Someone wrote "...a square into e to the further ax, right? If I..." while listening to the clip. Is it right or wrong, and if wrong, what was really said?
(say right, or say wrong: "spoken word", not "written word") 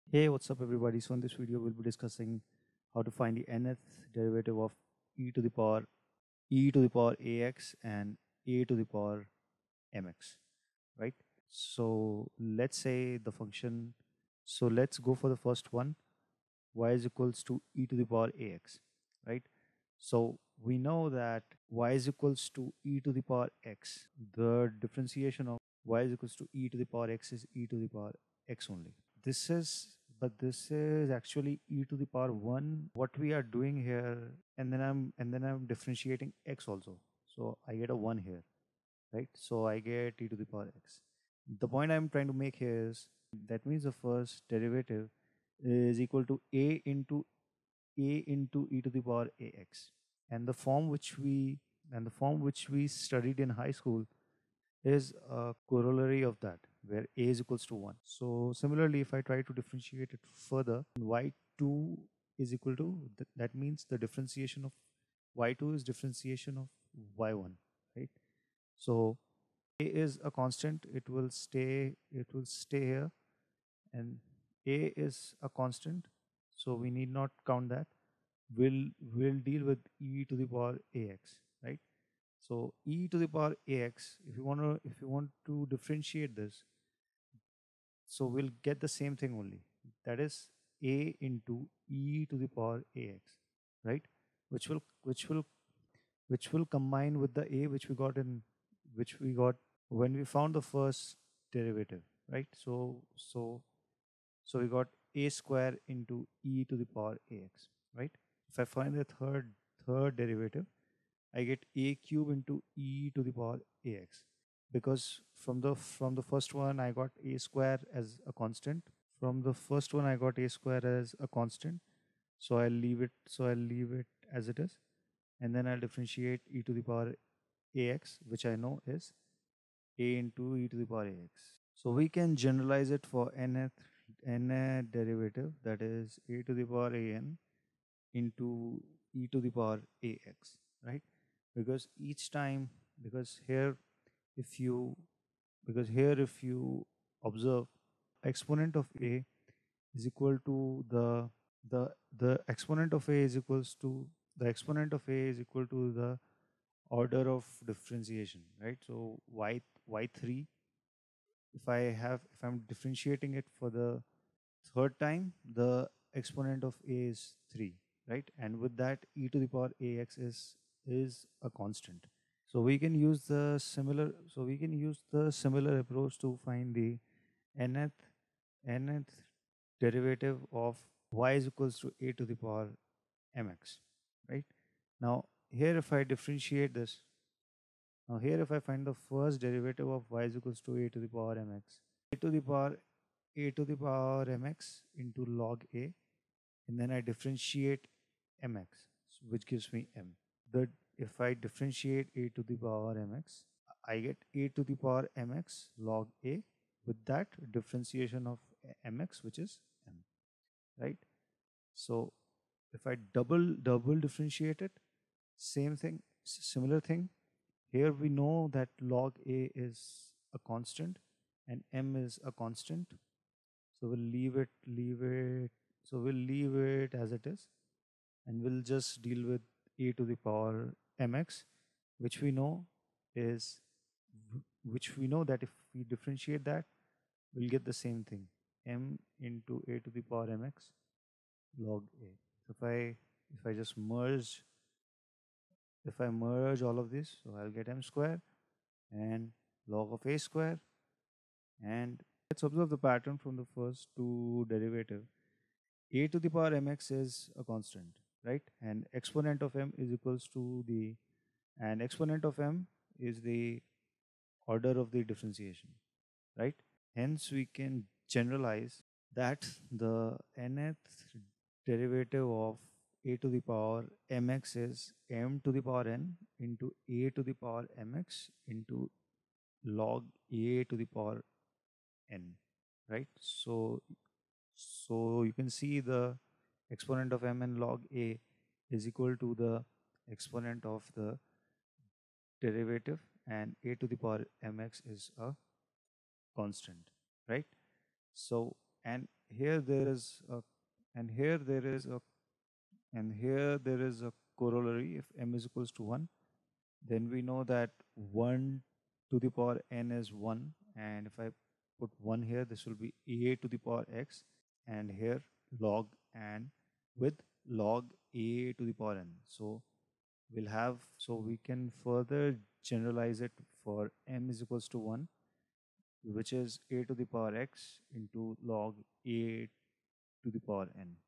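wrong: "power", not "further".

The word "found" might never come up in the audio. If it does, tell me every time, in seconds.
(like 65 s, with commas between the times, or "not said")
100 s.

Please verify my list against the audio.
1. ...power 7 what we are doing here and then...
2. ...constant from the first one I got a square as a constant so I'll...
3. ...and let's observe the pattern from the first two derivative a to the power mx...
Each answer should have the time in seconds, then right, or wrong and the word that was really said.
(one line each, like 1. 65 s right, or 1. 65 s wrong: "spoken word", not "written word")
1. 32 s wrong: "1", not "7"
2. 118 s right
3. 251 s right.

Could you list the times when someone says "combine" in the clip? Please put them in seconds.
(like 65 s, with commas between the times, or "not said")
96 s.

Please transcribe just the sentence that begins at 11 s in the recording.
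So let's say the function, so let's go for the first one, y is equals to e to the power ax, right?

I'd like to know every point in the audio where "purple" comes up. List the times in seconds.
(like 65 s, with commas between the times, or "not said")
not said.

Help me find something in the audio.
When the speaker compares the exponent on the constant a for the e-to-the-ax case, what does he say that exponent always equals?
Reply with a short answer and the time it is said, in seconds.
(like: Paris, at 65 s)
the order of differentiation, at 155 s.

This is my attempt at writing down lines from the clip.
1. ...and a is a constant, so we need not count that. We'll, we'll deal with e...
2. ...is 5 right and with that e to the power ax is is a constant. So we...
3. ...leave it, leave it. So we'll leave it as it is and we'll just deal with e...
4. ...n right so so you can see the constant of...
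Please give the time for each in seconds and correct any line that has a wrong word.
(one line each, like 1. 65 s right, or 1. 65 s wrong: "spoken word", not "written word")
1. 73 s right
2. 167 s wrong: "3", not "5"
3. 224 s right
4. 282 s wrong: "exponent", not "constant".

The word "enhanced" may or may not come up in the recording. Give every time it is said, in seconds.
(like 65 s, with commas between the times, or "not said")
not said.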